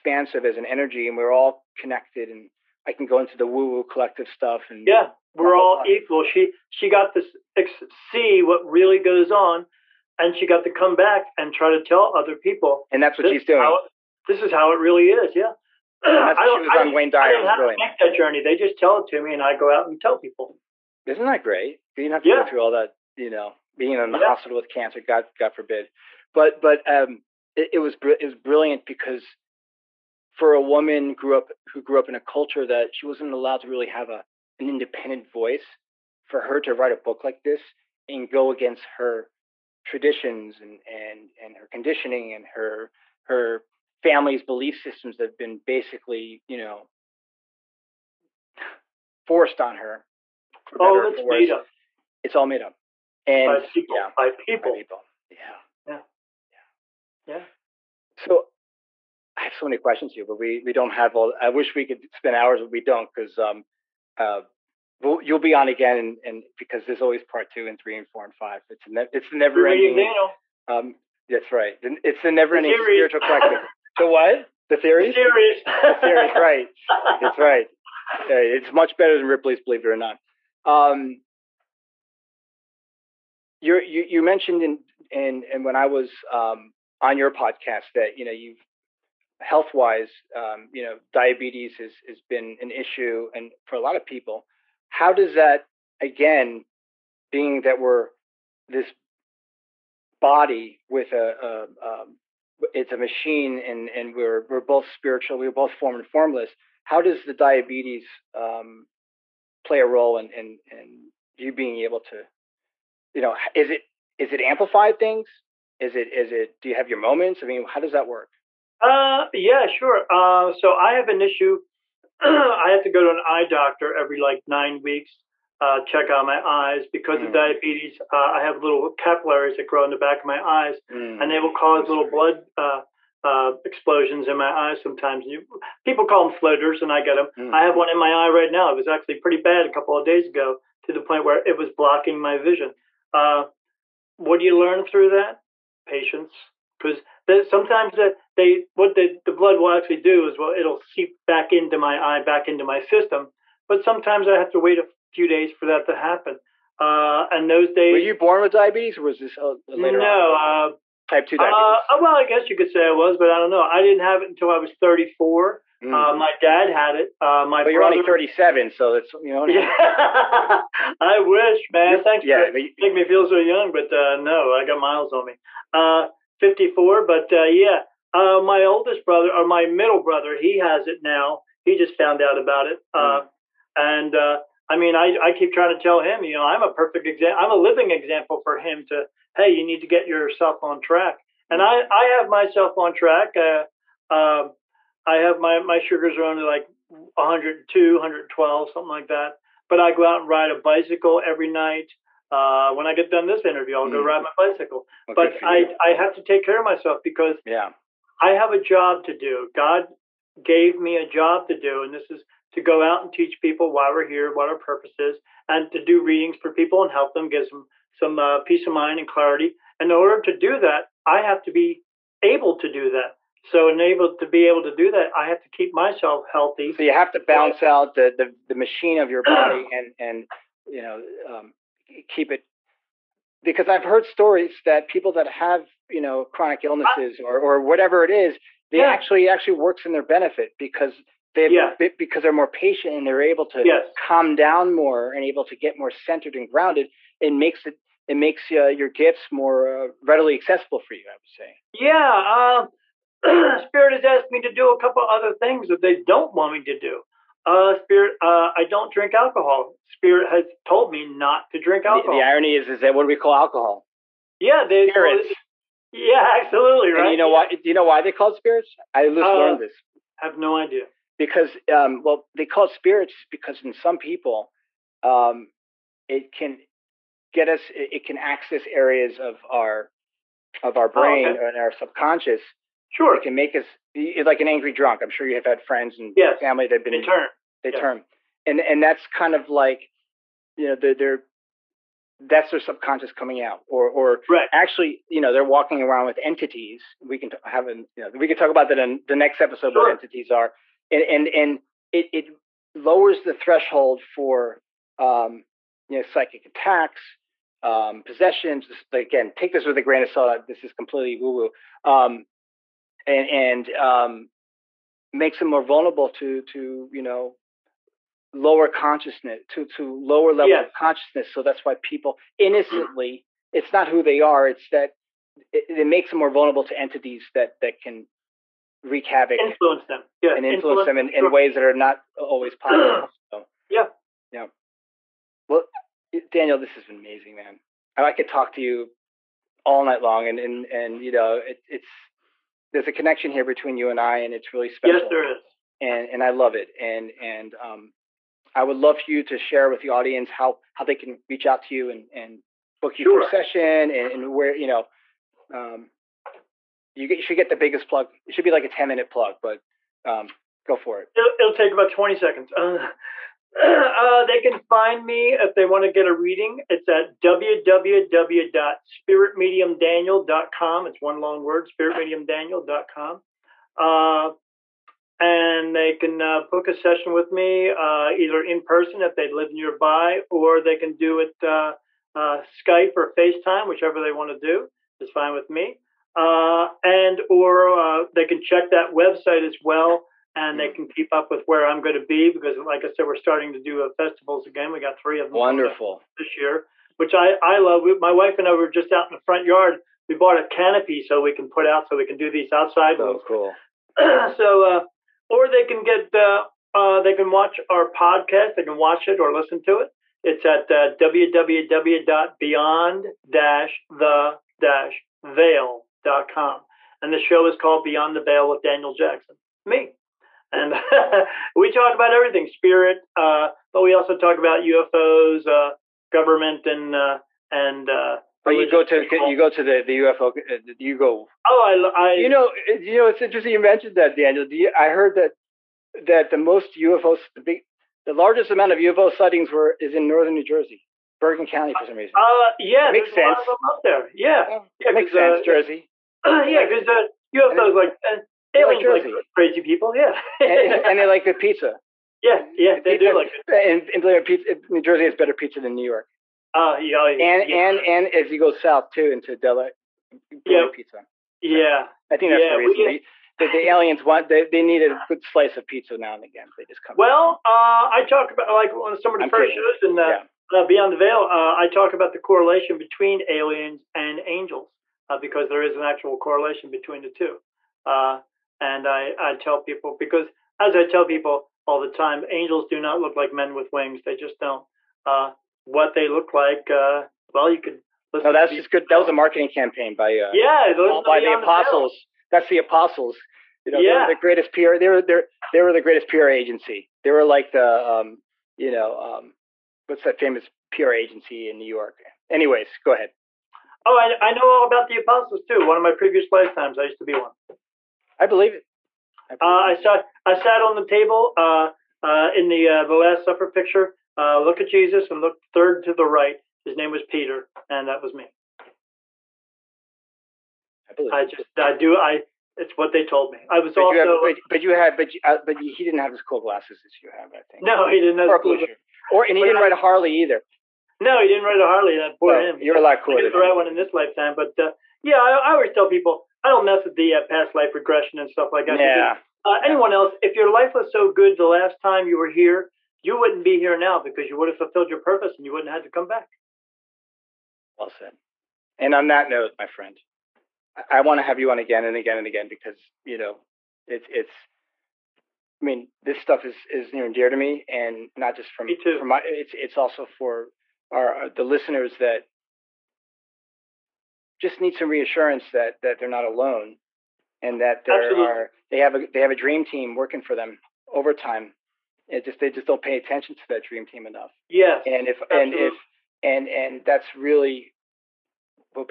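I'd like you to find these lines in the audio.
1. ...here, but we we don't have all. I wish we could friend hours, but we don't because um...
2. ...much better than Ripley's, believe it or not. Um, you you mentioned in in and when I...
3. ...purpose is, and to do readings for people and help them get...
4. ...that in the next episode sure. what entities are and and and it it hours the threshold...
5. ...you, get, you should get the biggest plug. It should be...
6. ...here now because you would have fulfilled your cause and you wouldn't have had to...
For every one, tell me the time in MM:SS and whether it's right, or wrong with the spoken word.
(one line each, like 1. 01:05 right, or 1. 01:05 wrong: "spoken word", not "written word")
1. 01:00 wrong: "spend", not "friend"
2. 01:18 right
3. 03:34 right
4. 04:58 wrong: "lowers", not "hours"
5. 05:56 right
6. 09:03 wrong: "purpose", not "cause".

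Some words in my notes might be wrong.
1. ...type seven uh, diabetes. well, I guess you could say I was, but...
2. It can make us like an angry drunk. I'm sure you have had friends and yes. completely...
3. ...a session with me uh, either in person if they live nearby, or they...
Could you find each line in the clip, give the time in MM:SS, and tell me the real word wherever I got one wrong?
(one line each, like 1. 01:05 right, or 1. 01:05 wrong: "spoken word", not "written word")
1. 02:41 wrong: "two", not "seven"
2. 04:43 wrong: "family", not "completely"
3. 06:16 right.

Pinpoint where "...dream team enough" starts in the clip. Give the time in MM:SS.
09:33.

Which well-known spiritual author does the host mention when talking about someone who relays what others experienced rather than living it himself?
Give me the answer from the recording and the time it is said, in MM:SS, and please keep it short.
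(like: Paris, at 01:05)
Wayne Dyer, at 00:16.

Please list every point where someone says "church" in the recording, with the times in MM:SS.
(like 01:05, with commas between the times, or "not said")
not said.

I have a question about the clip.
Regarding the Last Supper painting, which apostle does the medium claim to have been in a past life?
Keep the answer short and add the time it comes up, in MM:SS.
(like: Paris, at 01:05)
Peter, at 08:37.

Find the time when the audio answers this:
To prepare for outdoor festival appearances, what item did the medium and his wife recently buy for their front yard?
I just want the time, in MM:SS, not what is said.
06:40.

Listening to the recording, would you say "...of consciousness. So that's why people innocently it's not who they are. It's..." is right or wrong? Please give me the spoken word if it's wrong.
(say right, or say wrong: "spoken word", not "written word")
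right.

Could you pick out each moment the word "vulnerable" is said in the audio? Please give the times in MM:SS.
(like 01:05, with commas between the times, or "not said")
05:15, 05:26.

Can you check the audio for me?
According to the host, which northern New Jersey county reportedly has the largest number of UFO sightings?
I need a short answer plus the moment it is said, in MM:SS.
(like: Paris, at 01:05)
Bergen County, at 07:21.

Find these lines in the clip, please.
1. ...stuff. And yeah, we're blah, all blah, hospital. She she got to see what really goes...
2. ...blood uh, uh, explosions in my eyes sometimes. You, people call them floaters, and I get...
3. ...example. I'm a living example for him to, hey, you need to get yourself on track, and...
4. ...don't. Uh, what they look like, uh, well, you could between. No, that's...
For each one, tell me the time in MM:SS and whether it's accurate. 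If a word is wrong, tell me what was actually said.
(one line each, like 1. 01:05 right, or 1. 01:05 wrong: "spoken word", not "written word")
1. 00:04 wrong: "equal", not "hospital"
2. 02:12 right
3. 03:07 right
4. 08:04 wrong: "listen", not "between".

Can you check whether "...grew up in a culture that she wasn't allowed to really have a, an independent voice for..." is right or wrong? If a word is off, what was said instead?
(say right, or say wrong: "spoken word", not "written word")
right.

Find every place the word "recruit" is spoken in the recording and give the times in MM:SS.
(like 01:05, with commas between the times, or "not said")
not said.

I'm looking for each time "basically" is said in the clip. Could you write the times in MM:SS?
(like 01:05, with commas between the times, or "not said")
00:45.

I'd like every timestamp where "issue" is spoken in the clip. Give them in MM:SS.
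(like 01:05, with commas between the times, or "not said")
01:32, 02:01.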